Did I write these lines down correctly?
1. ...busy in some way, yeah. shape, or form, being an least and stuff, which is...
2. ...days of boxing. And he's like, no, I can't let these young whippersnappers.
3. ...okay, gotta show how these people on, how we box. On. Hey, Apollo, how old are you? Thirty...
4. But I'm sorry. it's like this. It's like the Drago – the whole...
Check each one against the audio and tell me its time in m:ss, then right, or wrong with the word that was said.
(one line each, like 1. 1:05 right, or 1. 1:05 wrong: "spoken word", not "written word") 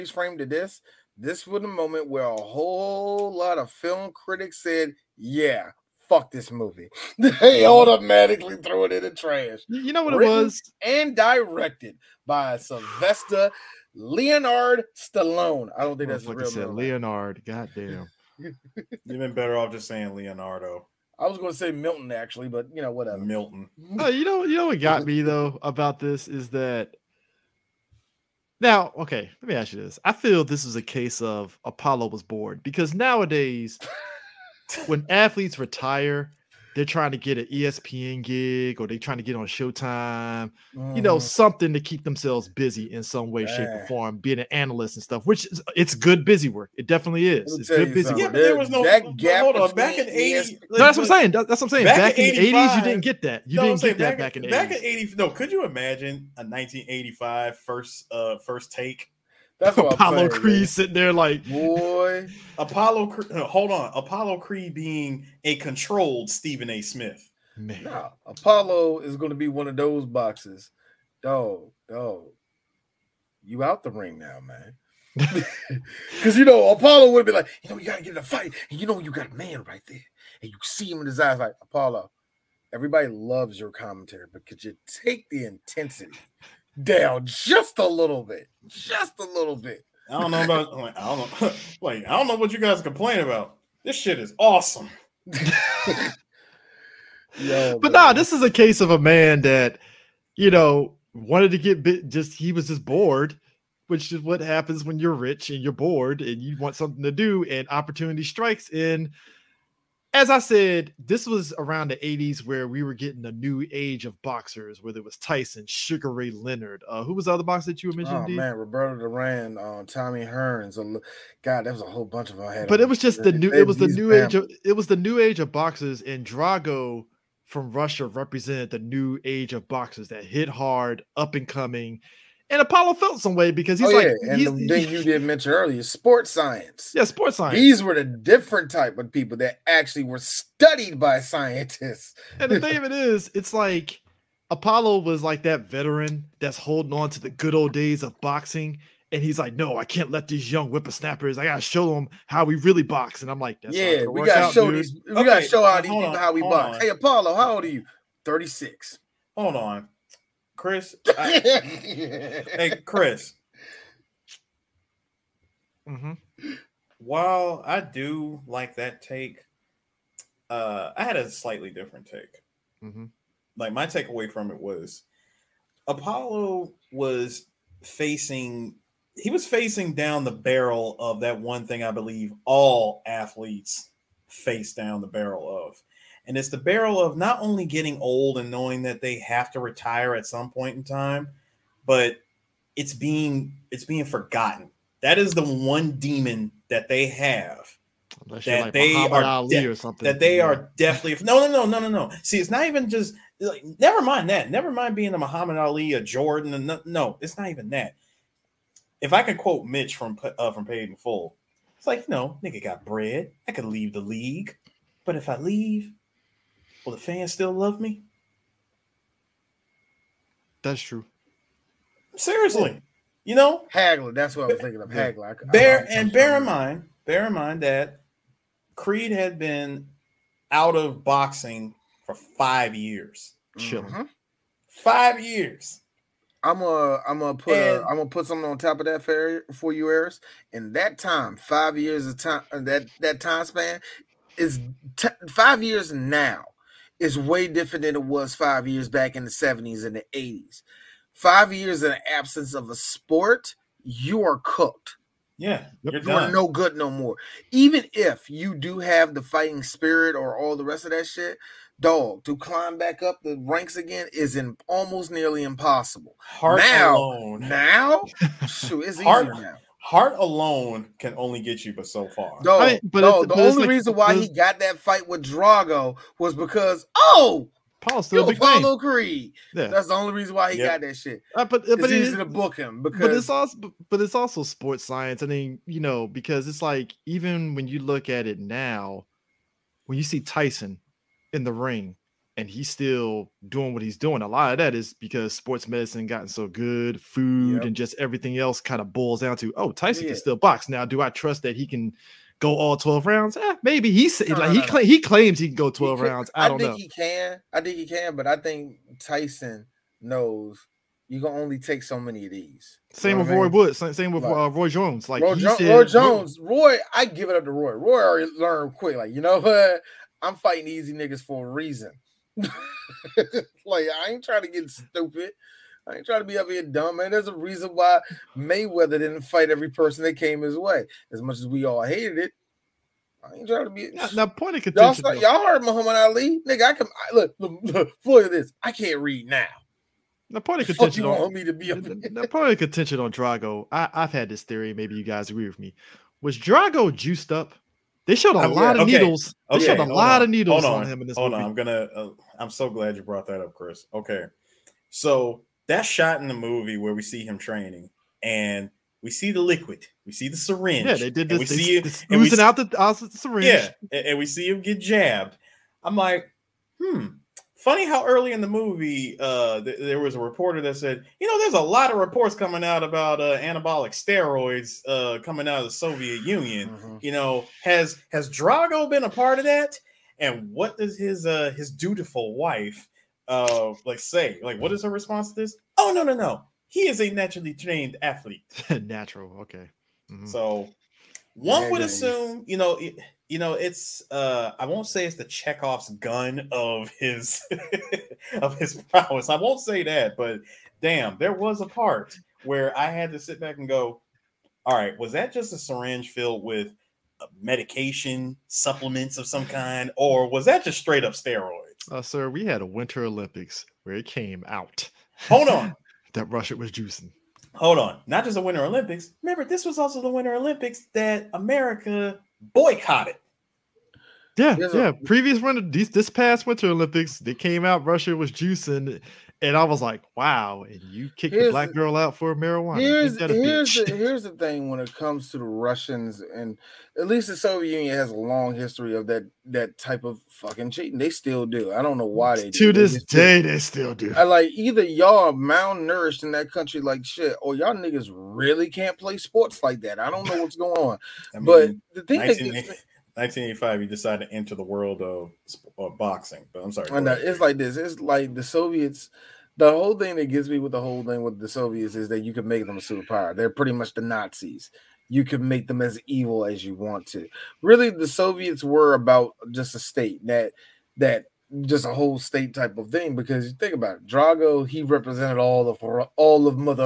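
1. 0:42 wrong: "analyst", not "least"
2. 2:27 right
3. 2:35 right
4. 7:36 wrong: "Soviets", not "Drago".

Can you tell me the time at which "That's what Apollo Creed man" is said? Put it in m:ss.
0:59.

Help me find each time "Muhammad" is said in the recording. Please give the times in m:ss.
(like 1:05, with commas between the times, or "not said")
3:25, 5:35.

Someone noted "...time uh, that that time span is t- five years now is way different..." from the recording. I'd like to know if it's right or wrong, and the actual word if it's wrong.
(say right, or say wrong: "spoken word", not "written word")
right.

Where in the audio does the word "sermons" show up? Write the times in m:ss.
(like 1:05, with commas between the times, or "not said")
not said.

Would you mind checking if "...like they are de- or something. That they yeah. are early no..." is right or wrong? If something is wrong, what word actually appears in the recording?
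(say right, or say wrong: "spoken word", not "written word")
wrong: "definitely", not "early".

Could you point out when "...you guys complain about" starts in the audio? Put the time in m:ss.
1:32.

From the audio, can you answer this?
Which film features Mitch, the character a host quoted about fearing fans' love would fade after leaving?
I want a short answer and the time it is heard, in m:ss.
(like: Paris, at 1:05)
Paid in Full, at 3:30.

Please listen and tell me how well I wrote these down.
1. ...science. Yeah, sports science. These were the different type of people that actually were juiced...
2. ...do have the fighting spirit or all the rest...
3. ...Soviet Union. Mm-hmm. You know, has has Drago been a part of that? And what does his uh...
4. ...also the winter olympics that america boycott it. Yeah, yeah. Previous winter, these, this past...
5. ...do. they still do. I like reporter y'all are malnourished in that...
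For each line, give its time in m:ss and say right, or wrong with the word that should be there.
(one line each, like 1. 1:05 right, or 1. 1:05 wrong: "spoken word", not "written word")
1. 2:16 wrong: "studied", not "juiced"
2. 4:18 right
3. 6:15 right
4. 6:59 right
5. 7:23 wrong: "either", not "reporter".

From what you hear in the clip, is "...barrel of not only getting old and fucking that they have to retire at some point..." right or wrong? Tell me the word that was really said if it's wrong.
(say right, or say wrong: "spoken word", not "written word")
wrong: "knowing", not "fucking".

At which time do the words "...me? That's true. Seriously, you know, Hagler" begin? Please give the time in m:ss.
3:37.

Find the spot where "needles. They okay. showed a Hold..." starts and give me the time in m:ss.
5:48.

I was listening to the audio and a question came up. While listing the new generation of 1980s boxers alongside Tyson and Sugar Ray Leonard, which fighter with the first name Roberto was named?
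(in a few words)
Roberto Duran.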